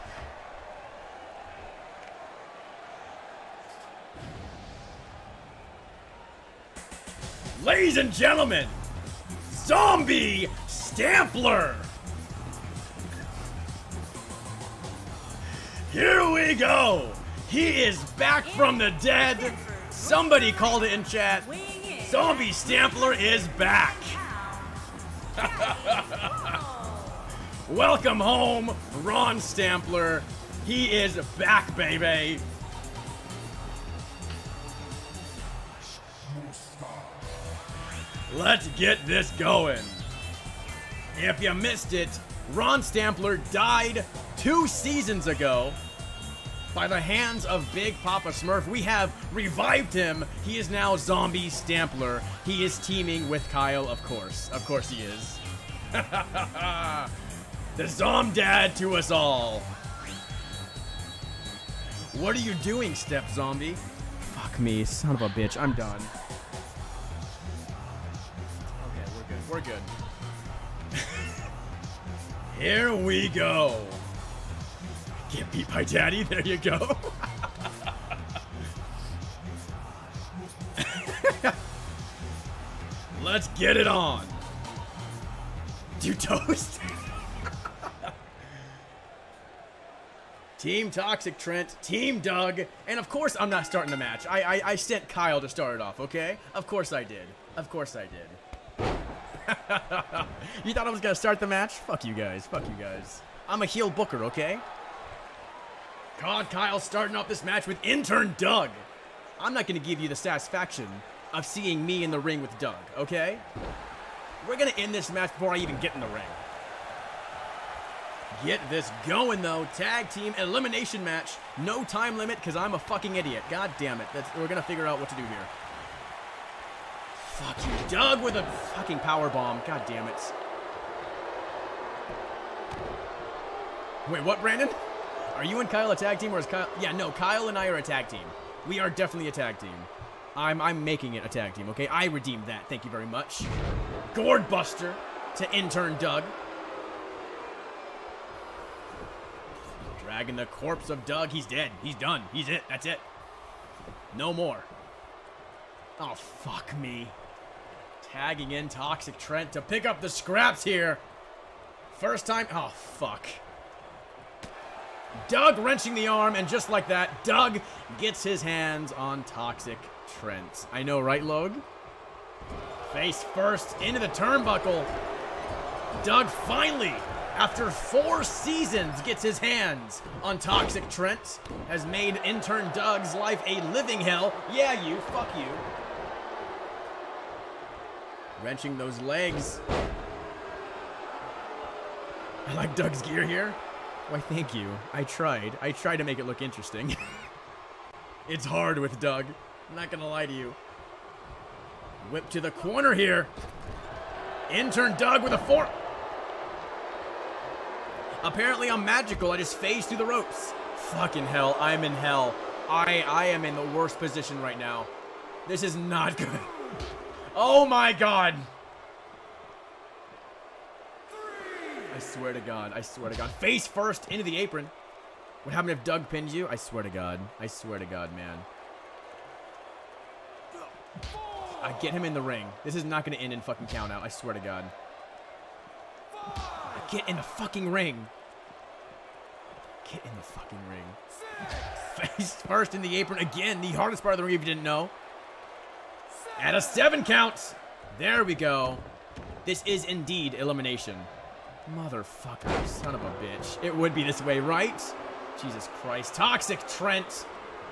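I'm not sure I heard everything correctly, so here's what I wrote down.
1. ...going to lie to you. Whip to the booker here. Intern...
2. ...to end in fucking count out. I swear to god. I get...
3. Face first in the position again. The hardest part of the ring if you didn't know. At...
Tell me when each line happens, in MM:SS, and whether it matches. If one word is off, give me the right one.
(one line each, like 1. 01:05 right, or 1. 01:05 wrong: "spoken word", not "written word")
1. 03:19 wrong: "corner", not "booker"
2. 03:53 right
3. 04:02 wrong: "apron", not "position".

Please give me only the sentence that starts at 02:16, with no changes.
Yeah, no, Kyle and I are a tag team.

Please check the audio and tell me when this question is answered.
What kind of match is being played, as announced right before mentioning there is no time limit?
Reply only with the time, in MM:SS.
01:59.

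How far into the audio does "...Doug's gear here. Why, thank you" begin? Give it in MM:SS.
03:12.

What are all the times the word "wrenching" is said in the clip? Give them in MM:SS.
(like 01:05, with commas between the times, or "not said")
02:45, 03:08.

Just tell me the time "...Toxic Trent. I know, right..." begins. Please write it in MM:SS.
02:49.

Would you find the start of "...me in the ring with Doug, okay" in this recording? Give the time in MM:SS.
01:51.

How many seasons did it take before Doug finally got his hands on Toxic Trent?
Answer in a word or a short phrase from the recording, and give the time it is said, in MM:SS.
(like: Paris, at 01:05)
4, at 02:57.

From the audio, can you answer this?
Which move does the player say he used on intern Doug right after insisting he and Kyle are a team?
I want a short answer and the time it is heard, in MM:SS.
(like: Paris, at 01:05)
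Gourd Buster, at 02:24.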